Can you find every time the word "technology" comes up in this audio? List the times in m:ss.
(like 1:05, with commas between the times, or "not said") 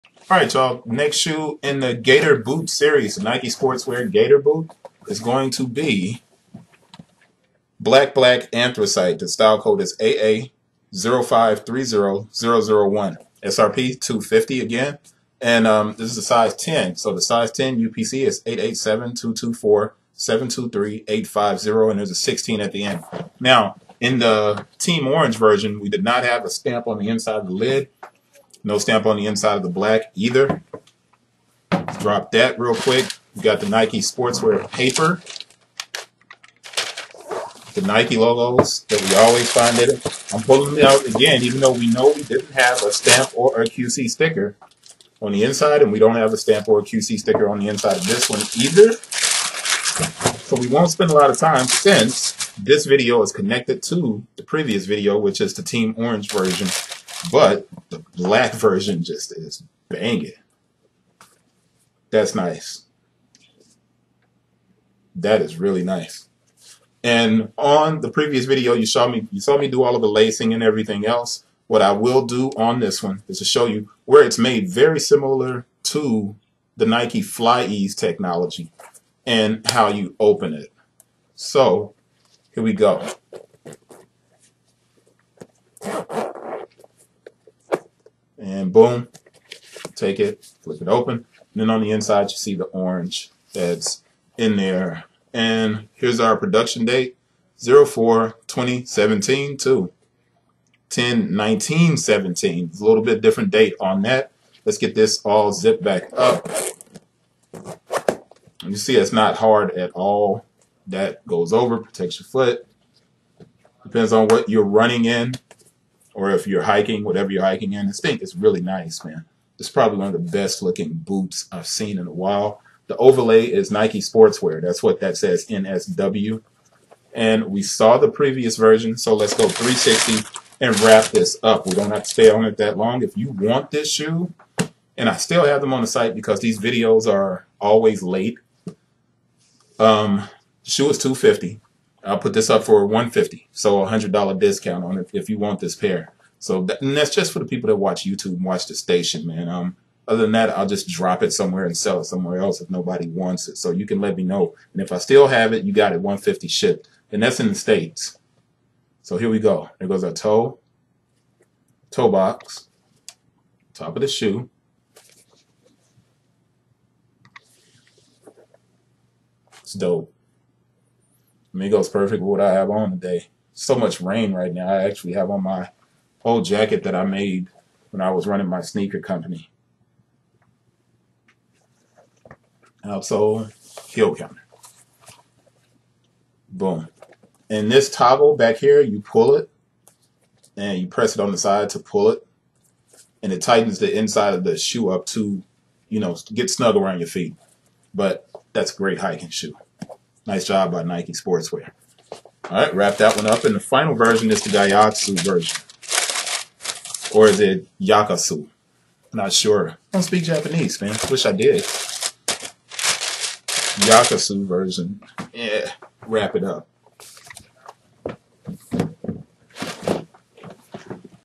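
1:17.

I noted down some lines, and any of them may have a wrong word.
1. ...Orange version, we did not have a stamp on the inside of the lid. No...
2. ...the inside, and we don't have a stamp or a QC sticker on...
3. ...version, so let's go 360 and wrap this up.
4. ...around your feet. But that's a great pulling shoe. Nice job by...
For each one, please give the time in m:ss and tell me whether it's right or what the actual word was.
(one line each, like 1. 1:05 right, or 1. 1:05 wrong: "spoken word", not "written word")
1. 0:25 right
2. 0:45 right
3. 2:08 right
4. 3:16 wrong: "hiking", not "pulling".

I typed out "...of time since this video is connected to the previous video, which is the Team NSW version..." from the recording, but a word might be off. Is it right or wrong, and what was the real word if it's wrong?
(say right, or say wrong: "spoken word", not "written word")
wrong: "Orange", not "NSW".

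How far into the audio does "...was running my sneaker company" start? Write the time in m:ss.
2:58.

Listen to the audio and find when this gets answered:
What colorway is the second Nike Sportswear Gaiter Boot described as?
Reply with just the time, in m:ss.
0:07.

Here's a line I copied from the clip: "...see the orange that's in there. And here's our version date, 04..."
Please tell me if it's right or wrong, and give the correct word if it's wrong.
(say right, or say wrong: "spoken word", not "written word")
wrong: "production", not "version".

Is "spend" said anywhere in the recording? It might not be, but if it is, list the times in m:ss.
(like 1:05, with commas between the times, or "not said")
0:50.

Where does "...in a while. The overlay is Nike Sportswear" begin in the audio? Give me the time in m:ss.
2:01.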